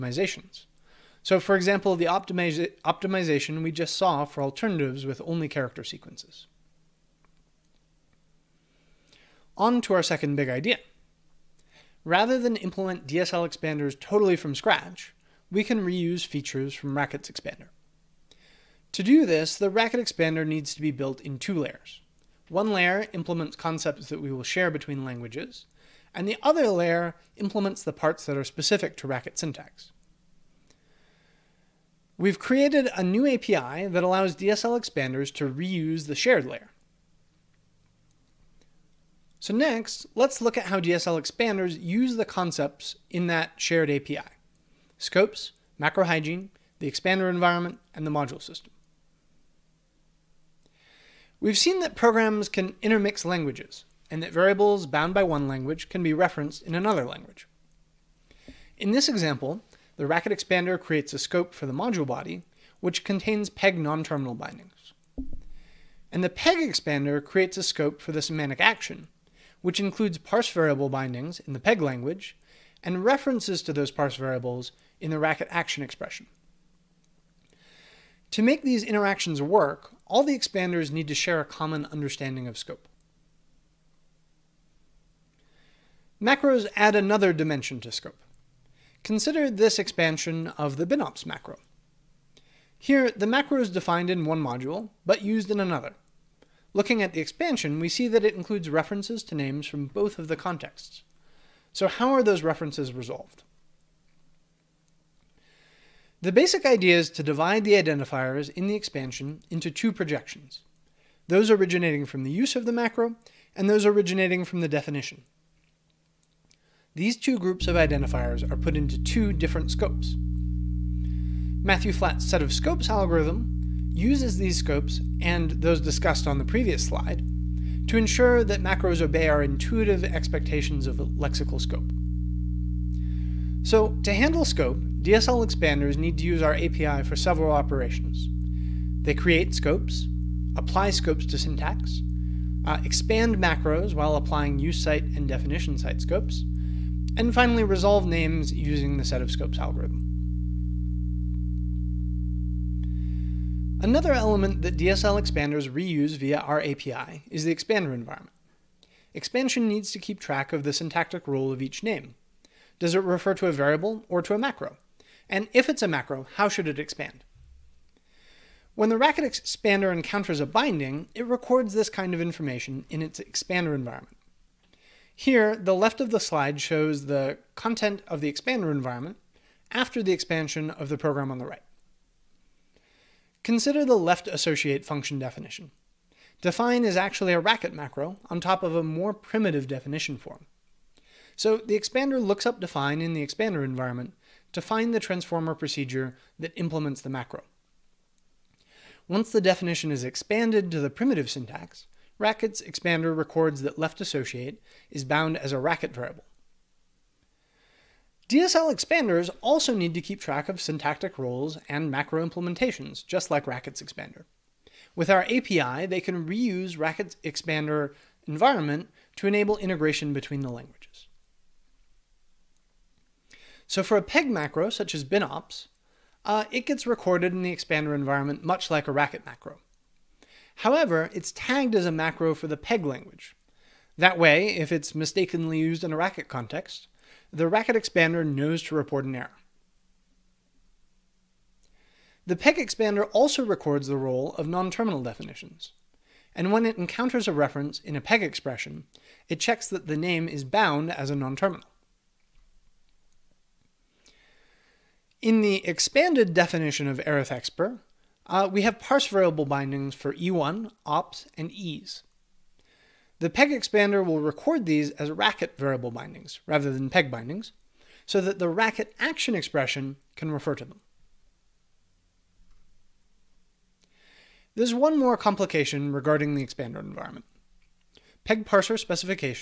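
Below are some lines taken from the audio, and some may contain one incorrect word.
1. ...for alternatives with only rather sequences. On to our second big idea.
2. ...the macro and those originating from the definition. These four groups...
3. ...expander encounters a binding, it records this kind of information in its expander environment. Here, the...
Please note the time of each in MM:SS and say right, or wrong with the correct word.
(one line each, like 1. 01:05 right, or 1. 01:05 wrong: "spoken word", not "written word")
1. 00:04 wrong: "character", not "rather"
2. 01:52 wrong: "two", not "four"
3. 02:49 right.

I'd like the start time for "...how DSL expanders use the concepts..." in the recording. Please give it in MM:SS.
00:40.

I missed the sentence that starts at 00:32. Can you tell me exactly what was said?
We've created a new API that allows DSL expanders to reuse the shared layer.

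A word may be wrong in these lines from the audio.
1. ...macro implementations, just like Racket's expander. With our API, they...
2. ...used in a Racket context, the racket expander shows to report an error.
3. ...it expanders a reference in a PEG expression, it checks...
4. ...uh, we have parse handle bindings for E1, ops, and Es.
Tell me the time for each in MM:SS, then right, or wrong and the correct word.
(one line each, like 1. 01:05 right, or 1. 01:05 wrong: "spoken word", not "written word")
1. 03:31 right
2. 03:55 wrong: "knows", not "shows"
3. 04:06 wrong: "encounters", not "expanders"
4. 04:18 wrong: "variable", not "handle".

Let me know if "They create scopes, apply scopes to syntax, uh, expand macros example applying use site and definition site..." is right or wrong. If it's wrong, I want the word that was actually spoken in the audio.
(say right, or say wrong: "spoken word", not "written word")
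wrong: "while", not "example".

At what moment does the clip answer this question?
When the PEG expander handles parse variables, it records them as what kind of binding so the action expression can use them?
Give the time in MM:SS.
04:25.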